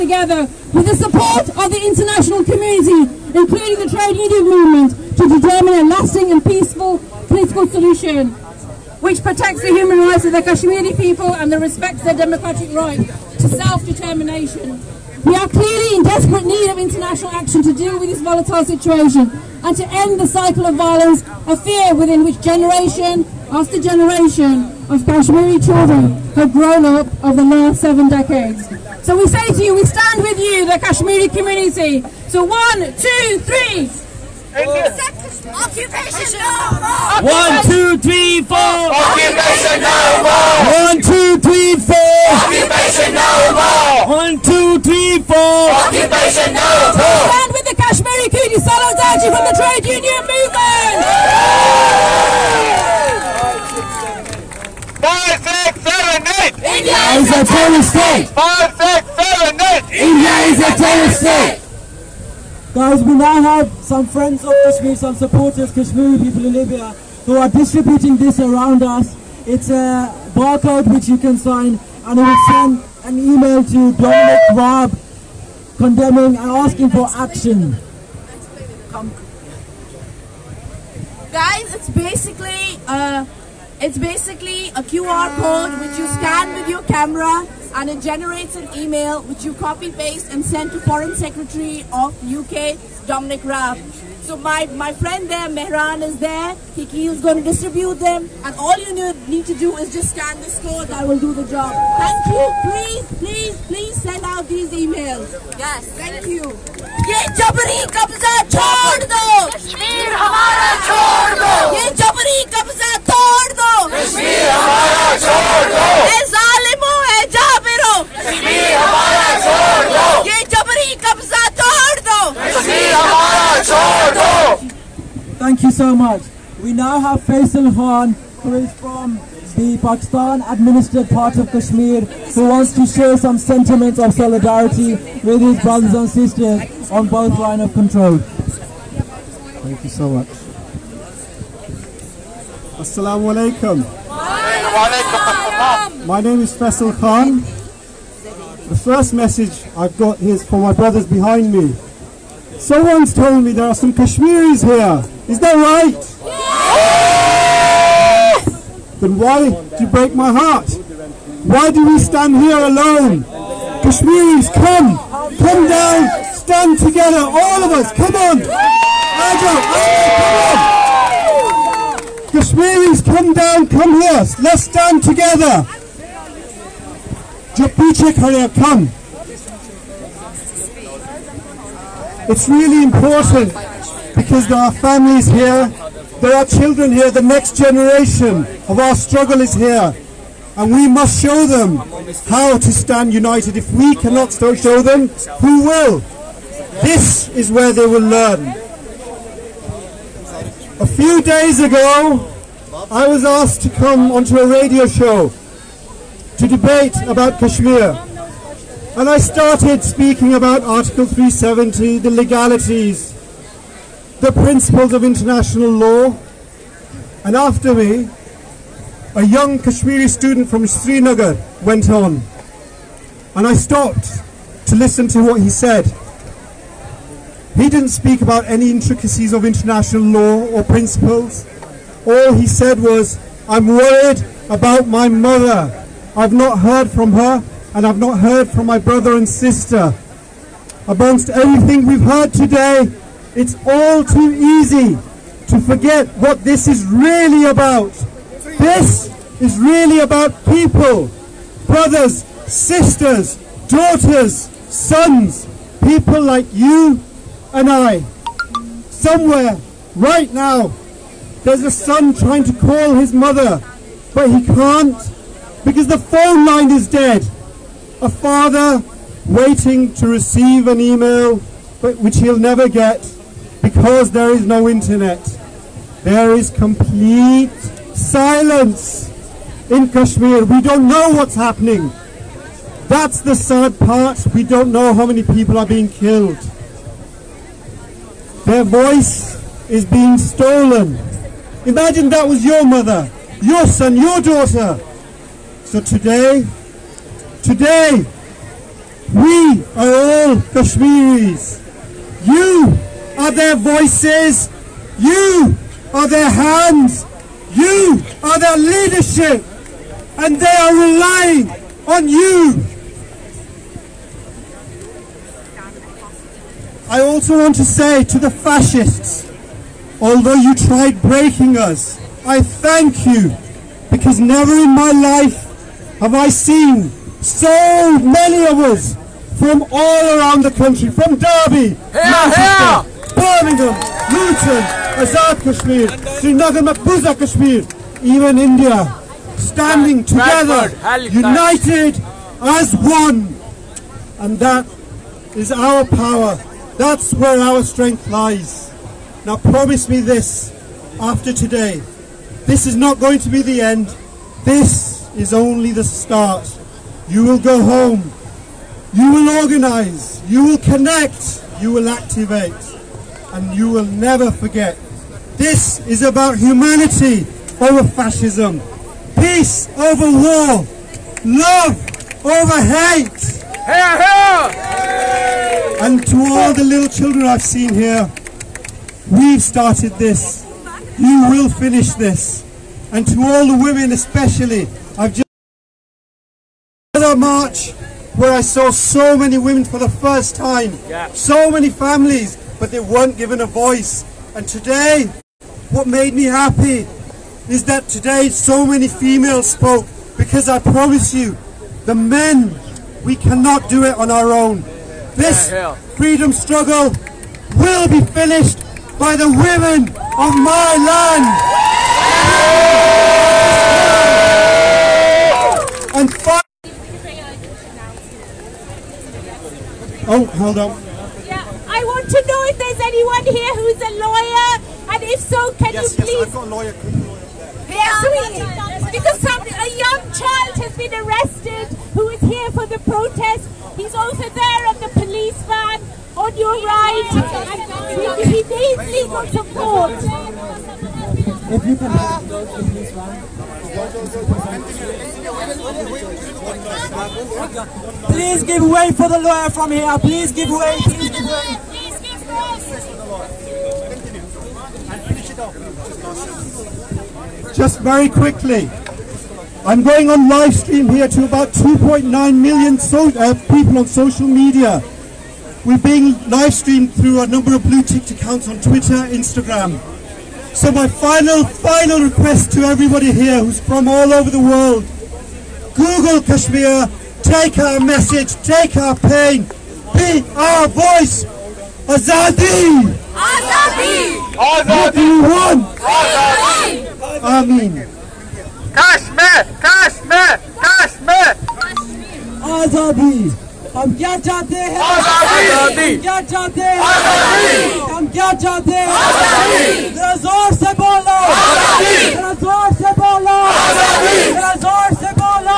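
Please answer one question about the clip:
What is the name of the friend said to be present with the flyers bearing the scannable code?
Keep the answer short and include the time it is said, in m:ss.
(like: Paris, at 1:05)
Mehran, at 1:35.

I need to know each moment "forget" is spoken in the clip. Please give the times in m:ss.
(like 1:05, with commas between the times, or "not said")
4:05, 6:04.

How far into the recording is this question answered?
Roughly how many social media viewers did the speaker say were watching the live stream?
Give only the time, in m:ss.
7:41.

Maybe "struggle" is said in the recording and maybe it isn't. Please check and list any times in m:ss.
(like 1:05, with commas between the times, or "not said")
3:08, 6:46.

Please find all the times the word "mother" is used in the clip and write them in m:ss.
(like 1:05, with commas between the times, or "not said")
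3:55, 4:23, 4:52.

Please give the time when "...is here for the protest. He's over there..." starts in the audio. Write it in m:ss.
7:12.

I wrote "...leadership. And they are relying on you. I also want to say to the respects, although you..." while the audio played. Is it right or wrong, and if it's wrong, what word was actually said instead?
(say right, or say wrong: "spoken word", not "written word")
wrong: "fascists", not "respects".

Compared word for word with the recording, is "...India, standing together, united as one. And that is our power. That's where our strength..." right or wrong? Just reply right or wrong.
right.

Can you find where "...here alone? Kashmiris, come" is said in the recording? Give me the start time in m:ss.
2:42.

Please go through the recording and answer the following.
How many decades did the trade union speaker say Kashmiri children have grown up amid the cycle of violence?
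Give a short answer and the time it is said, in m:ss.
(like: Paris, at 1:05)
7, at 0:27.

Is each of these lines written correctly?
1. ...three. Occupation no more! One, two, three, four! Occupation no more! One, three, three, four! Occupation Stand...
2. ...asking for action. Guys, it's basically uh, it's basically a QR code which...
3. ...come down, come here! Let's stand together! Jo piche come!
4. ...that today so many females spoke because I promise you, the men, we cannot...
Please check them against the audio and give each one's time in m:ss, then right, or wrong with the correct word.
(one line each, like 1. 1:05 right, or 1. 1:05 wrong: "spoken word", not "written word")
1. 0:33 wrong: "two", not "three"
2. 1:16 right
3. 2:53 right
4. 6:37 right.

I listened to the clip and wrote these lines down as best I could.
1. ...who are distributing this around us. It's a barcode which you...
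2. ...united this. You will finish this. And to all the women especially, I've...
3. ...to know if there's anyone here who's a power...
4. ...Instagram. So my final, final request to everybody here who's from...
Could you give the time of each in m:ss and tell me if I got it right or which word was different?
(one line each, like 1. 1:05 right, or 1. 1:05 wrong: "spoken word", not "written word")
1. 1:07 right
2. 6:19 wrong: "started", not "united"
3. 7:02 wrong: "lawyer", not "power"
4. 7:49 right.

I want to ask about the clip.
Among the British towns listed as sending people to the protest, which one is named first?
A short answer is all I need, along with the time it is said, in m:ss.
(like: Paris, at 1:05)
Derby, at 5:31.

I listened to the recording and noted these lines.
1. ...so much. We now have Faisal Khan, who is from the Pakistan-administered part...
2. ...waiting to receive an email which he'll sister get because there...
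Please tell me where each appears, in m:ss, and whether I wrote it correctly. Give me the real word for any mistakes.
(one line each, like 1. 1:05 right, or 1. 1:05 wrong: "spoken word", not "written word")
1. 2:05 right
2. 4:29 wrong: "never", not "sister".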